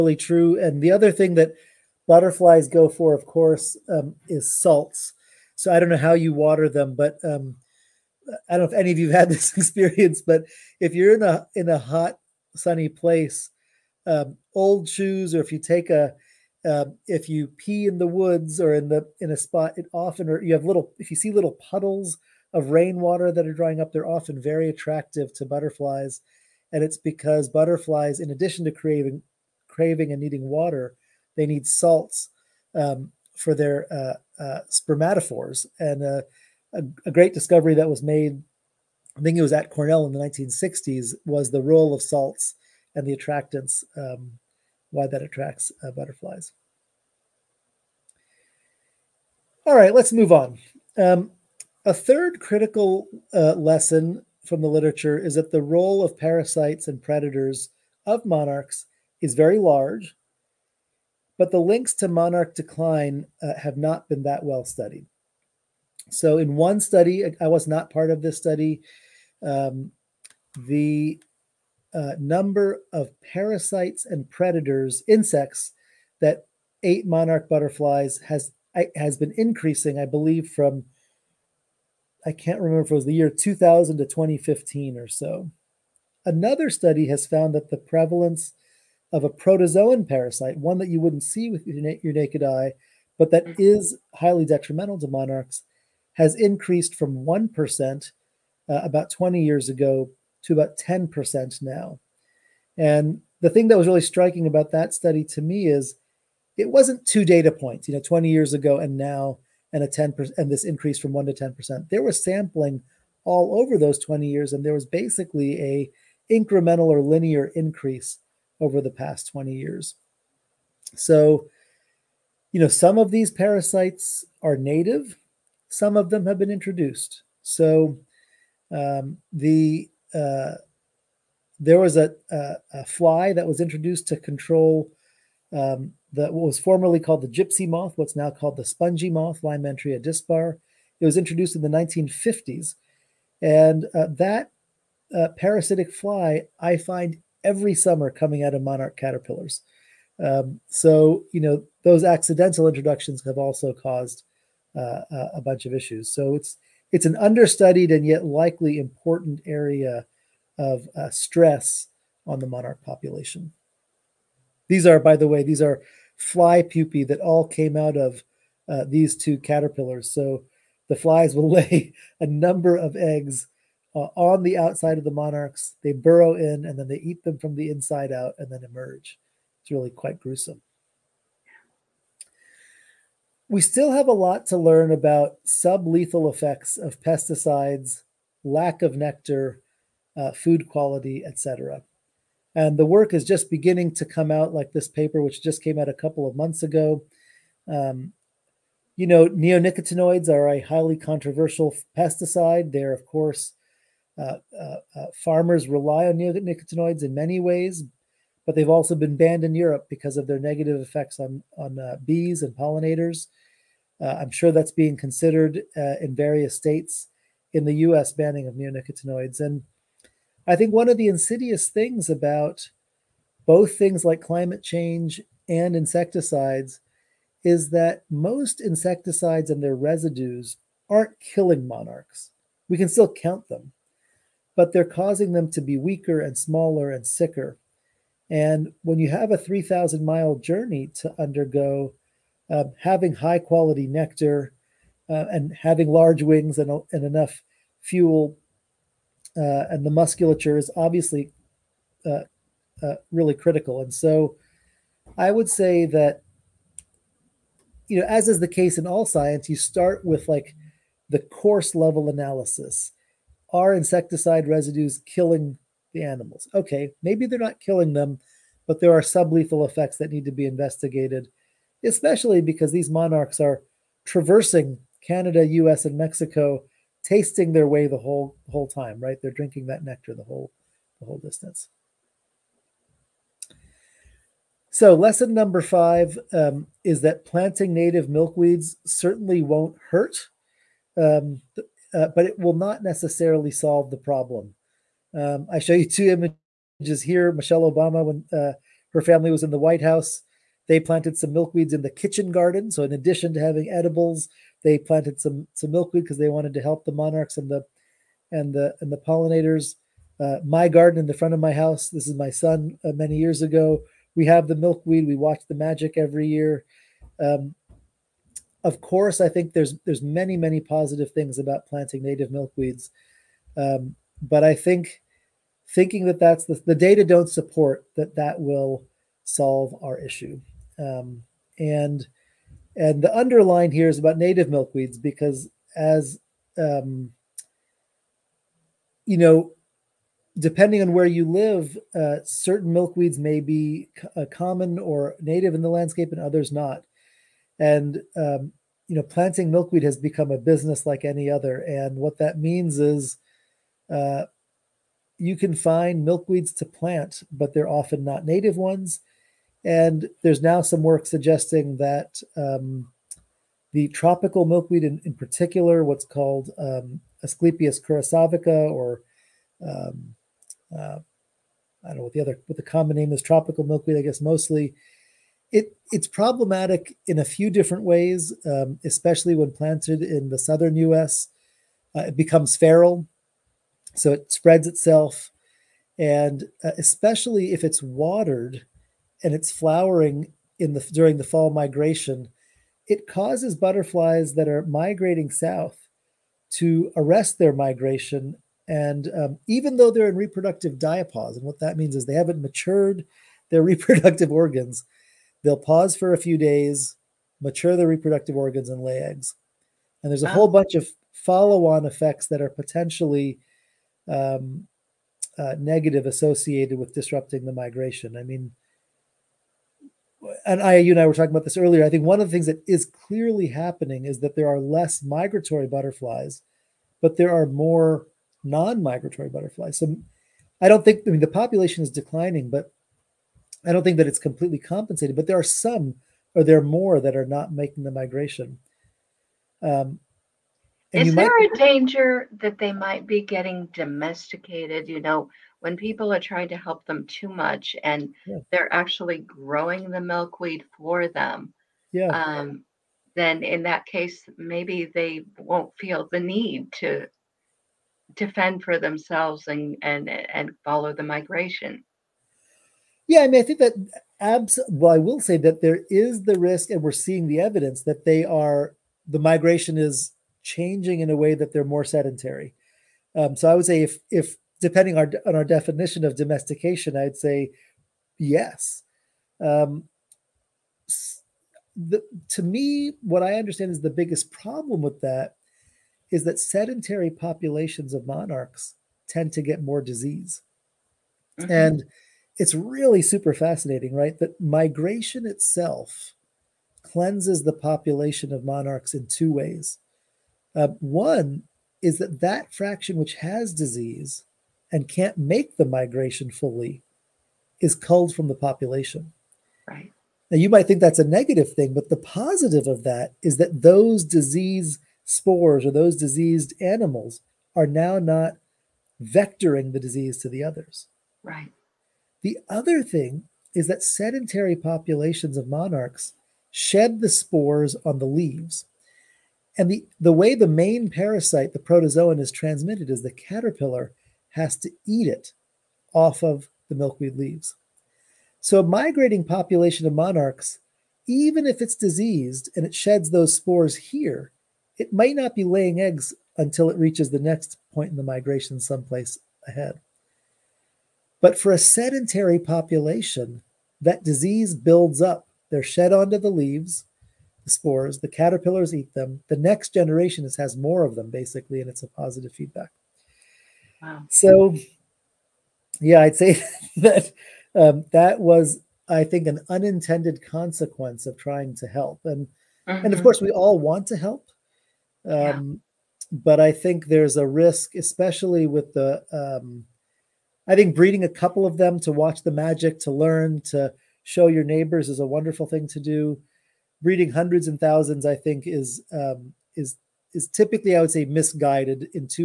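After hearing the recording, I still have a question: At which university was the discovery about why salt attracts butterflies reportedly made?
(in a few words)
Cornell.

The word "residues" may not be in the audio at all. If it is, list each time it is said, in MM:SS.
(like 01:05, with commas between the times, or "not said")
03:49, 04:24.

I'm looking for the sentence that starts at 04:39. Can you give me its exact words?
They're drinking that nectar the whole the whole distance.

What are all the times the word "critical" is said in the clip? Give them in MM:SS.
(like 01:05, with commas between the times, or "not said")
00:52, 04:13.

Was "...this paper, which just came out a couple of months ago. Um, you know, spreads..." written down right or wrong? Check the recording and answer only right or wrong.
wrong.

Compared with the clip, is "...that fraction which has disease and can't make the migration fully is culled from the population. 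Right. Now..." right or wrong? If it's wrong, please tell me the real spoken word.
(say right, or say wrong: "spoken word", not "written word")
right.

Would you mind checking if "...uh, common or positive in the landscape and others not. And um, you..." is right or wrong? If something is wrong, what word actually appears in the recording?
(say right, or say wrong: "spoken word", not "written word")
wrong: "native", not "positive".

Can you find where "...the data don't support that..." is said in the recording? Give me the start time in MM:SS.
05:26.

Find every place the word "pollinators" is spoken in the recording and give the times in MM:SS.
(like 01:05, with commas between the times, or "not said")
03:32, 05:08.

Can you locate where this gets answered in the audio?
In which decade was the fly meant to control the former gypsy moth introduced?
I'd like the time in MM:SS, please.
02:21.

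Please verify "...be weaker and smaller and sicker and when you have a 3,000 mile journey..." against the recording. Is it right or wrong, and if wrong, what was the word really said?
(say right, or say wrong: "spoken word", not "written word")
right.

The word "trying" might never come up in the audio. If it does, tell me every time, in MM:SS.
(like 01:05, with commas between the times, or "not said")
07:26, 09:31.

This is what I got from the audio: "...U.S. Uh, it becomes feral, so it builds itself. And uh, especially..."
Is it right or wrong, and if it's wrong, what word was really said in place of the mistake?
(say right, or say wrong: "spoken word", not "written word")
wrong: "spreads", not "builds".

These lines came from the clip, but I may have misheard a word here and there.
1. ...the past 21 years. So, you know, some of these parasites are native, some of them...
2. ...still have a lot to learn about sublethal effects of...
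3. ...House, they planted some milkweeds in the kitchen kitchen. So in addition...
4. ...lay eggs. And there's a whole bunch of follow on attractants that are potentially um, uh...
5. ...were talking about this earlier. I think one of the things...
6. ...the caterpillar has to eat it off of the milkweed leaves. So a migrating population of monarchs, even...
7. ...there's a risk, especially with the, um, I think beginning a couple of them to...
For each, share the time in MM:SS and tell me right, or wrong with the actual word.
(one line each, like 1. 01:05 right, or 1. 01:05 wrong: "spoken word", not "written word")
1. 01:58 wrong: "20", not "21"
2. 03:03 right
3. 04:59 wrong: "garden", not "kitchen"
4. 06:48 wrong: "effects", not "attractants"
5. 07:01 right
6. 08:53 right
7. 09:36 wrong: "breeding", not "beginning".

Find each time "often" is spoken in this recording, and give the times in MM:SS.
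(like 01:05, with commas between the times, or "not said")
00:19, 00:24, 05:57.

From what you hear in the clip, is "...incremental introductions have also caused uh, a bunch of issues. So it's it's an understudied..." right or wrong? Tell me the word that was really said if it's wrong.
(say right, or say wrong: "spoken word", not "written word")
wrong: "accidental", not "incremental".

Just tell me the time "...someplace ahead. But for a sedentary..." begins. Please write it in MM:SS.
09:08.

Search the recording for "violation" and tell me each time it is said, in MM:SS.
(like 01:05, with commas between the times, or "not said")
not said.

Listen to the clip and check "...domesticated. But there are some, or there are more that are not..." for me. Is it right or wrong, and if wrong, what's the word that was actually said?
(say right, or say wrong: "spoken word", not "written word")
wrong: "compensated", not "domesticated".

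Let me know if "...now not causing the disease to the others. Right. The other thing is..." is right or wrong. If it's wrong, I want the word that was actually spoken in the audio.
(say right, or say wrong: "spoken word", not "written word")
wrong: "vectoring", not "causing".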